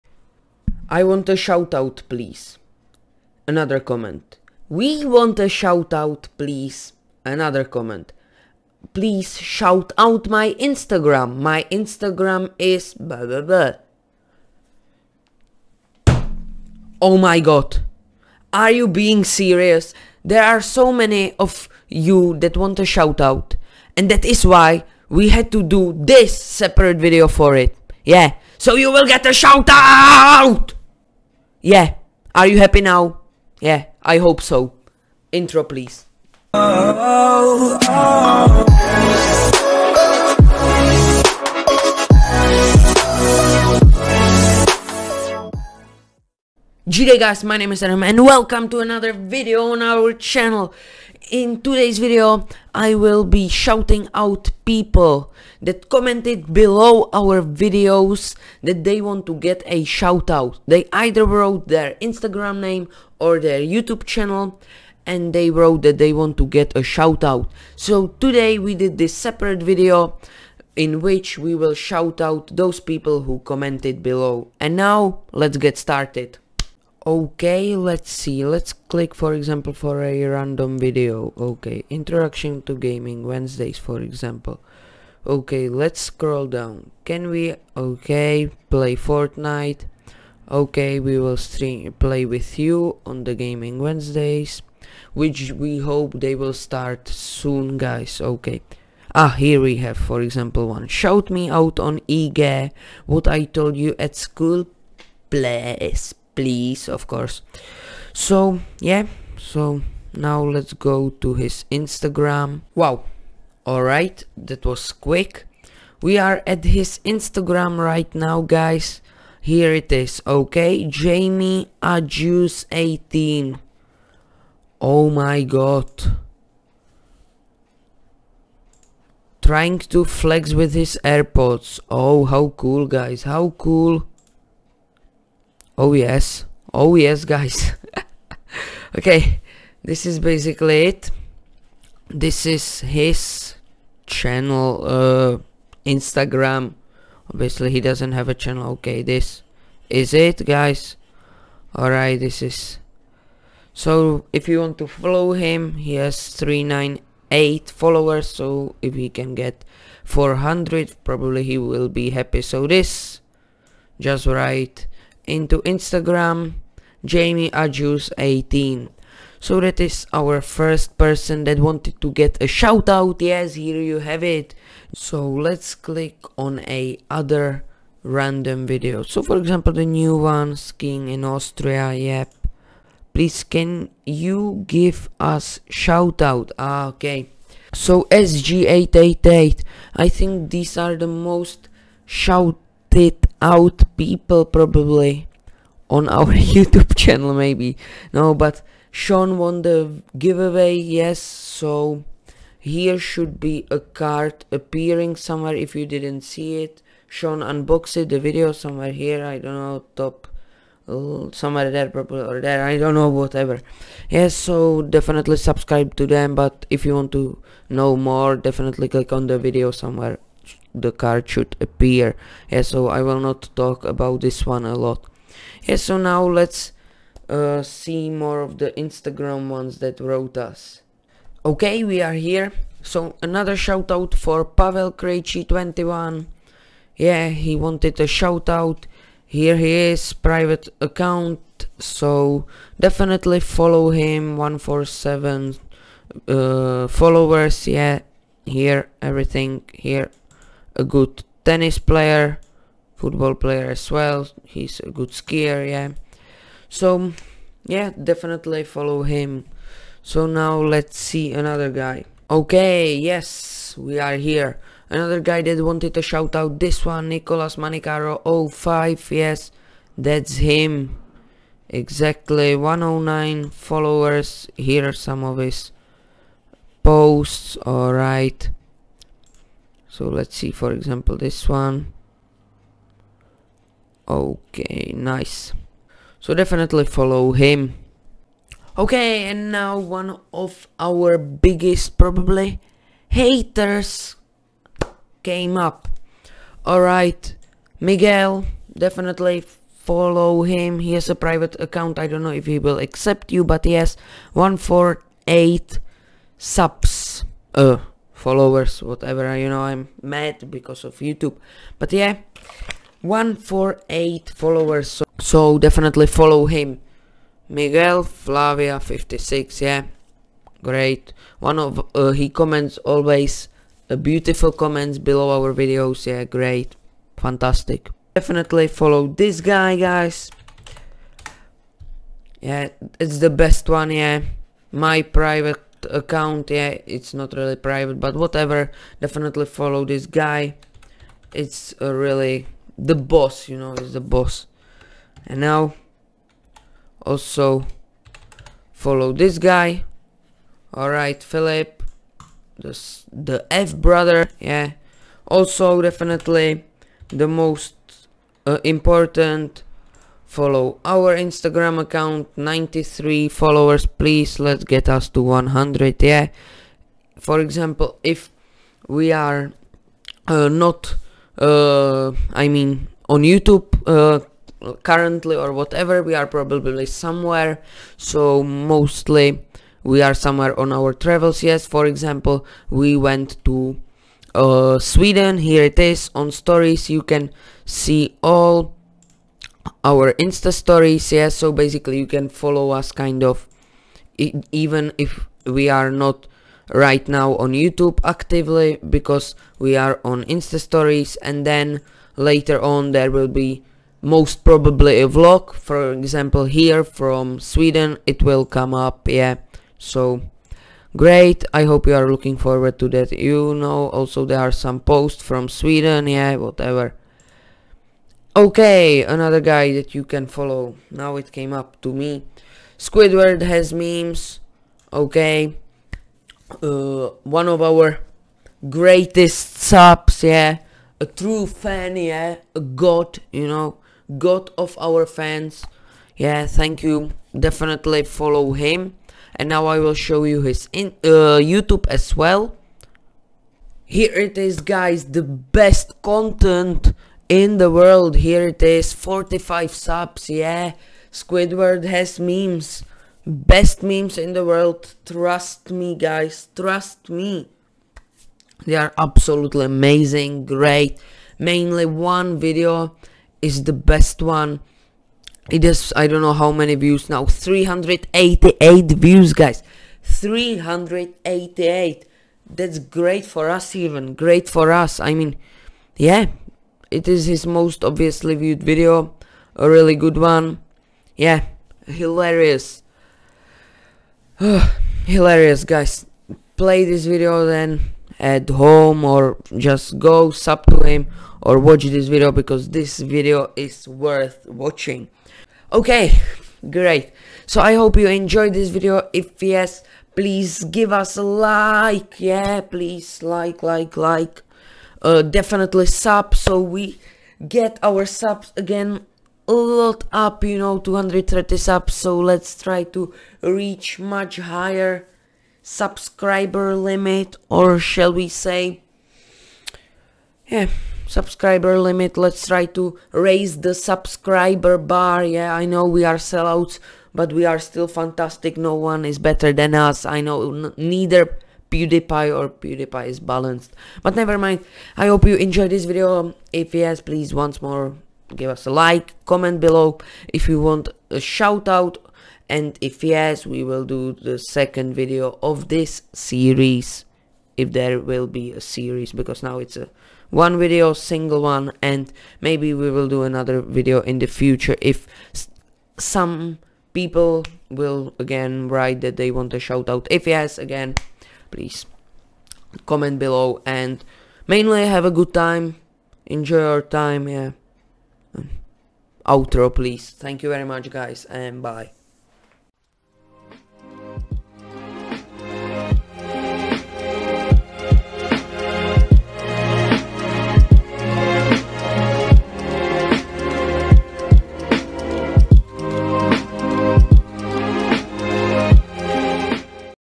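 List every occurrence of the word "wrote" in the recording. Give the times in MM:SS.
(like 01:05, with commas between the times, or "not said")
01:01, 01:05, 03:49.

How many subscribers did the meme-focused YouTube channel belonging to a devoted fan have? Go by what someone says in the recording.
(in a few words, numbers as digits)
45.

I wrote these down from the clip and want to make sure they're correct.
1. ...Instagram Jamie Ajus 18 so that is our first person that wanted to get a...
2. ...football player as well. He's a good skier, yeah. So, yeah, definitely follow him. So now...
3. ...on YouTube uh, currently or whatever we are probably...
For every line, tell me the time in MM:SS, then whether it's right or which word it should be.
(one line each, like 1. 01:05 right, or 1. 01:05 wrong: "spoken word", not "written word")
1. 02:45 right
2. 04:12 right
3. 06:13 right.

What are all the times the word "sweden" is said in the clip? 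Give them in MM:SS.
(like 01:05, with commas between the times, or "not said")
06:24, 06:47, 06:55.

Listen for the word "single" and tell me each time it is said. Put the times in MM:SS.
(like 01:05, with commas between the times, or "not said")
09:10.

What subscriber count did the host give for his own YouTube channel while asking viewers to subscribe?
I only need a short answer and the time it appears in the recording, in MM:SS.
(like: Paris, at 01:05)
230, at 08:30.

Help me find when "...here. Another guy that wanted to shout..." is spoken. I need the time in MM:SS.
04:24.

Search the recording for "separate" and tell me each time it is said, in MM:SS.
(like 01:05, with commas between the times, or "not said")
00:26, 01:09.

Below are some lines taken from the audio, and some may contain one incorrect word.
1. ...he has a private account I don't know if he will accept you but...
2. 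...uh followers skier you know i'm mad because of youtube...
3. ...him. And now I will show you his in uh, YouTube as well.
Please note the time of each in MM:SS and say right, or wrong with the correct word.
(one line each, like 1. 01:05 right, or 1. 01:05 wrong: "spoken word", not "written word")
1. 05:00 right
2. 05:07 wrong: "whatever", not "skier"
3. 07:18 right.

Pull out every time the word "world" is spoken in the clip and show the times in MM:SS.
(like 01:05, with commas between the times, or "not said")
07:27, 07:34.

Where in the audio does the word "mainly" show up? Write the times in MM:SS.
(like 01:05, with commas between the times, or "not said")
07:41, 09:24.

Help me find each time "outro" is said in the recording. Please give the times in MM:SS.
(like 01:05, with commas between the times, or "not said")
09:29.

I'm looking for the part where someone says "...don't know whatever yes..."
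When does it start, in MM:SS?
03:32.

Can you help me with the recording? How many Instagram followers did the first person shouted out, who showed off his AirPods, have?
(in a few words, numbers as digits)
398.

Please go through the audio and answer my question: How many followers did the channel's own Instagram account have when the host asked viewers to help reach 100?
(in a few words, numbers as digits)
93.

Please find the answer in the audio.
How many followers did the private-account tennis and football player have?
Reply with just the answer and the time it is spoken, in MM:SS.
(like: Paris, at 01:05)
147, at 04:04.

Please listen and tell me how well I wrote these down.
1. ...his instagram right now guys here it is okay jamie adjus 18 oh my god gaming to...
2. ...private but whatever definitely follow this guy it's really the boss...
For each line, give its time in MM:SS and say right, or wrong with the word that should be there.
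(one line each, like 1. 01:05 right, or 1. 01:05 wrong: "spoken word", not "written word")
1. 01:56 wrong: "trying", not "gaming"
2. 05:37 right.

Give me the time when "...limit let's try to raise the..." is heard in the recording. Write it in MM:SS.
08:41.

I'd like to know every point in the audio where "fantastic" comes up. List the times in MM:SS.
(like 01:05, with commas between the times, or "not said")
05:27, 08:47.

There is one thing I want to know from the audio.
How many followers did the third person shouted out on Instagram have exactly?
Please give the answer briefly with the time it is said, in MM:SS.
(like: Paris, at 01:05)
109, at 04:32.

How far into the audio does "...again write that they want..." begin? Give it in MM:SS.
09:18.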